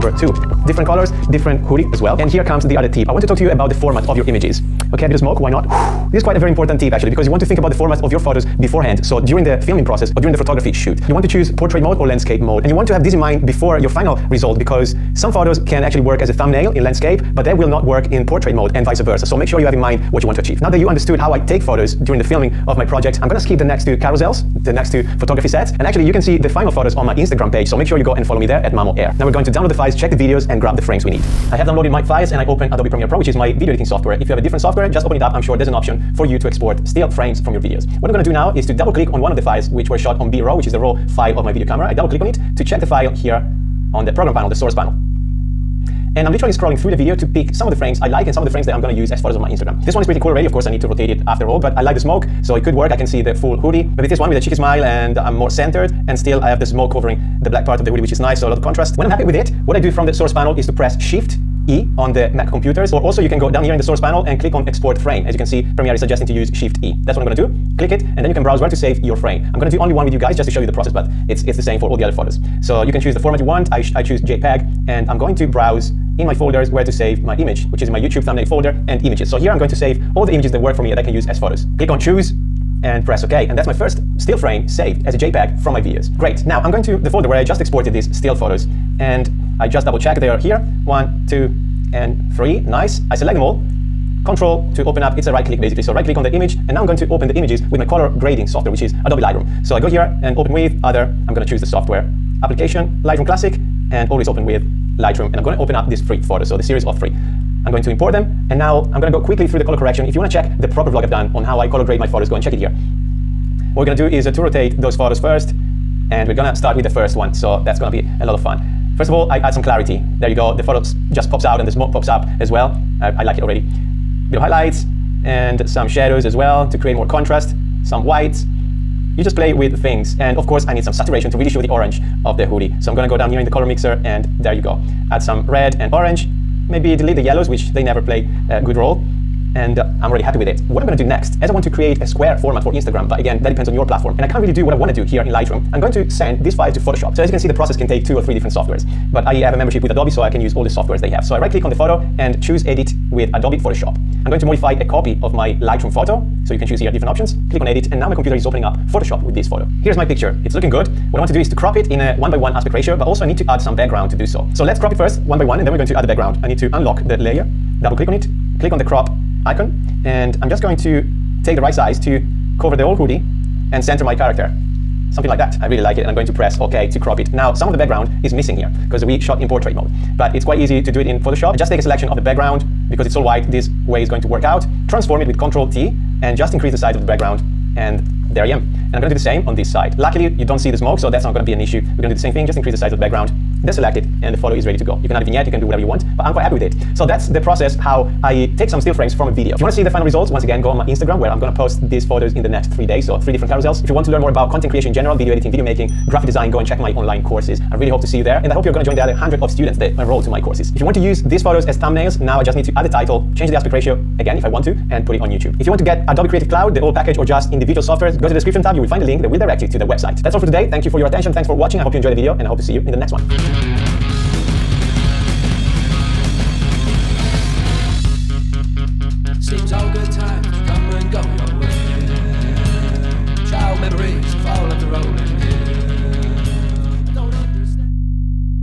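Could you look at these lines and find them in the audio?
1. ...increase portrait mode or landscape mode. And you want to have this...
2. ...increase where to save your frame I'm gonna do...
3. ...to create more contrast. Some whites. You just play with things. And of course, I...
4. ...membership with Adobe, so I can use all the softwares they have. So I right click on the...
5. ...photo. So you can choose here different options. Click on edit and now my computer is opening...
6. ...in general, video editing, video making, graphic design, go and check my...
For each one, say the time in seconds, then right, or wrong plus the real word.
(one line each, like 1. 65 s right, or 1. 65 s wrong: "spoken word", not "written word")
1. 11 s wrong: "choose", not "increase"
2. 68 s wrong: "browse", not "increase"
3. 126 s right
4. 149 s right
5. 155 s right
6. 204 s right.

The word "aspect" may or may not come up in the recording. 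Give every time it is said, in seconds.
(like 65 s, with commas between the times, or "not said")
162 s, 213 s.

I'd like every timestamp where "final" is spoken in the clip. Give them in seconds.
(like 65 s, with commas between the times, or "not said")
13 s, 26 s, 199 s.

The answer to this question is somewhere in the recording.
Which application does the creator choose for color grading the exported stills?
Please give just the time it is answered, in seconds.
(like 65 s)
103 s.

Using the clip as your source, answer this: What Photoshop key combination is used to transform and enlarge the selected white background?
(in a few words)
Control T.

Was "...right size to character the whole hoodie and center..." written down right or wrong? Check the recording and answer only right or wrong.
wrong.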